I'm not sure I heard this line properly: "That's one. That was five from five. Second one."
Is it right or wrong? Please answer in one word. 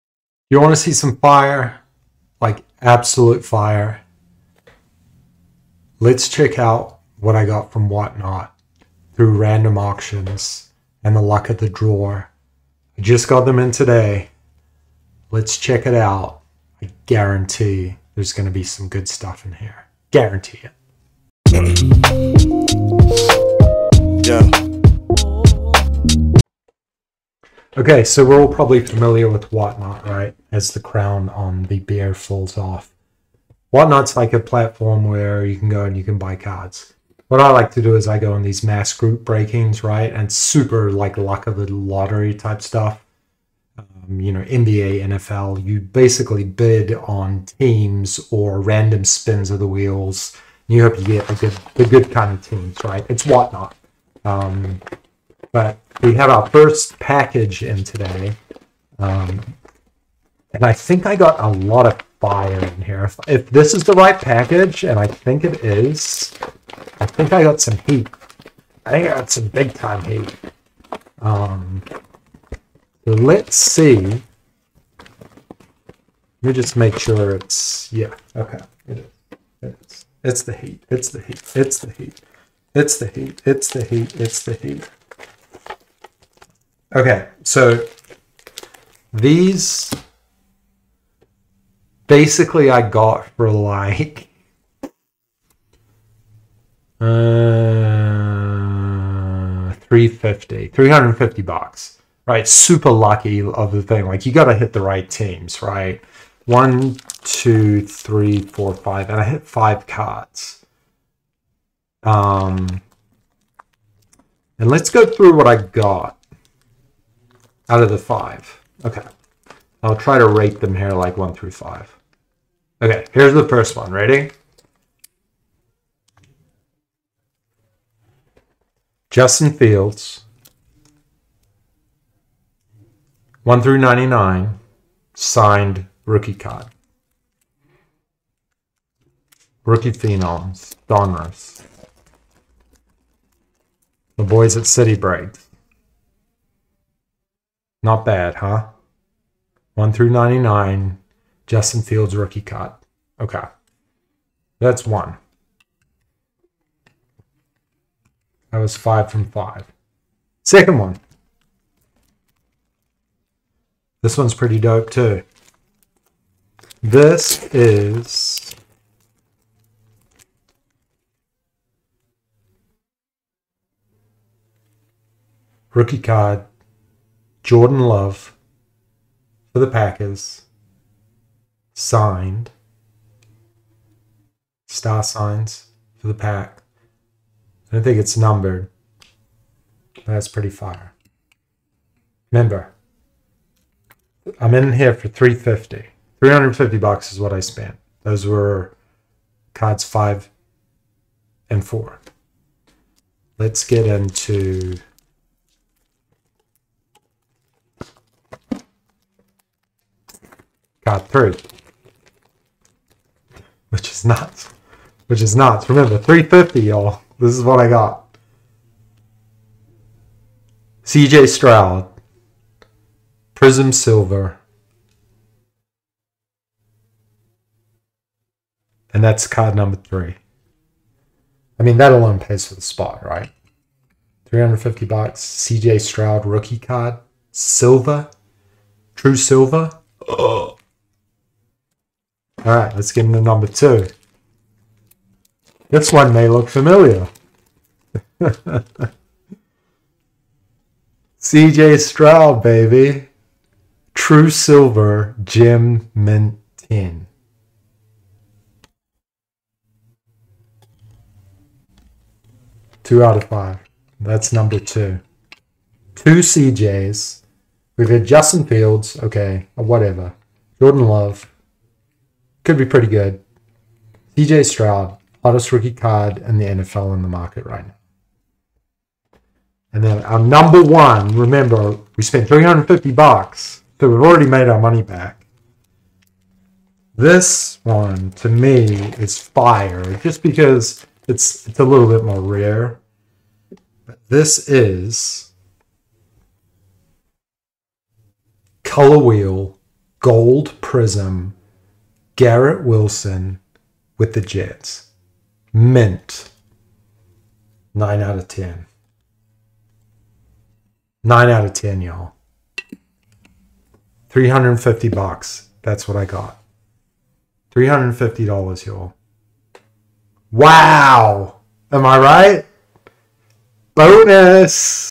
right.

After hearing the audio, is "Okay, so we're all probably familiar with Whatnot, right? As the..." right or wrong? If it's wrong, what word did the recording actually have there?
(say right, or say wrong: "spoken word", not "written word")
right.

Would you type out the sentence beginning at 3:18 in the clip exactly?
Those were cards five and four.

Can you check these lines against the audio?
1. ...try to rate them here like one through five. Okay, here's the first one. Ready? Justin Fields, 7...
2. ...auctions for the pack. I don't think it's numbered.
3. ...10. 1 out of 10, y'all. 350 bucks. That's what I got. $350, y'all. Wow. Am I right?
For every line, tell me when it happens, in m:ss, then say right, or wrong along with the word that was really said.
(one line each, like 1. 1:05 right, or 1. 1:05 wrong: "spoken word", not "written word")
1. 1:59 wrong: "1", not "7"
2. 3:05 wrong: "signs", not "auctions"
3. 5:08 wrong: "9", not "1".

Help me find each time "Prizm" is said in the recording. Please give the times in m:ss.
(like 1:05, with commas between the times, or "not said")
3:43, 5:00.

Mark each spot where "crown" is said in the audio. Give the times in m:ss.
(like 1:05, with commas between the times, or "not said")
0:30.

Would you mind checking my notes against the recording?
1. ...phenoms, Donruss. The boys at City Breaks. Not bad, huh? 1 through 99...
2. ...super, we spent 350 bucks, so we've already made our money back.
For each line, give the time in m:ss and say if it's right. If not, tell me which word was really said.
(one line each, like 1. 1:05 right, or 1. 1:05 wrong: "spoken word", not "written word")
1. 2:19 right
2. 4:41 wrong: "remember", not "super".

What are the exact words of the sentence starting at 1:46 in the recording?
One, two, three, four, five, and I hit five cards.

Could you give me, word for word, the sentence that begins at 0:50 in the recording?
You hope you get the good, the good kind of teams, right?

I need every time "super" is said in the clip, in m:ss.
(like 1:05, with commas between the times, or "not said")
0:40, 1:42.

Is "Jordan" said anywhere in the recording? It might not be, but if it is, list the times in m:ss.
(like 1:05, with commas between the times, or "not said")
2:57, 4:30.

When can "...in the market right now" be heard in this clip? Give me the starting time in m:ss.
4:36.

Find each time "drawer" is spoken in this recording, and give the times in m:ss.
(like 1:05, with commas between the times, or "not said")
0:11.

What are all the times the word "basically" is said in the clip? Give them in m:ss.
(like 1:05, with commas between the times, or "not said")
0:45, 1:32.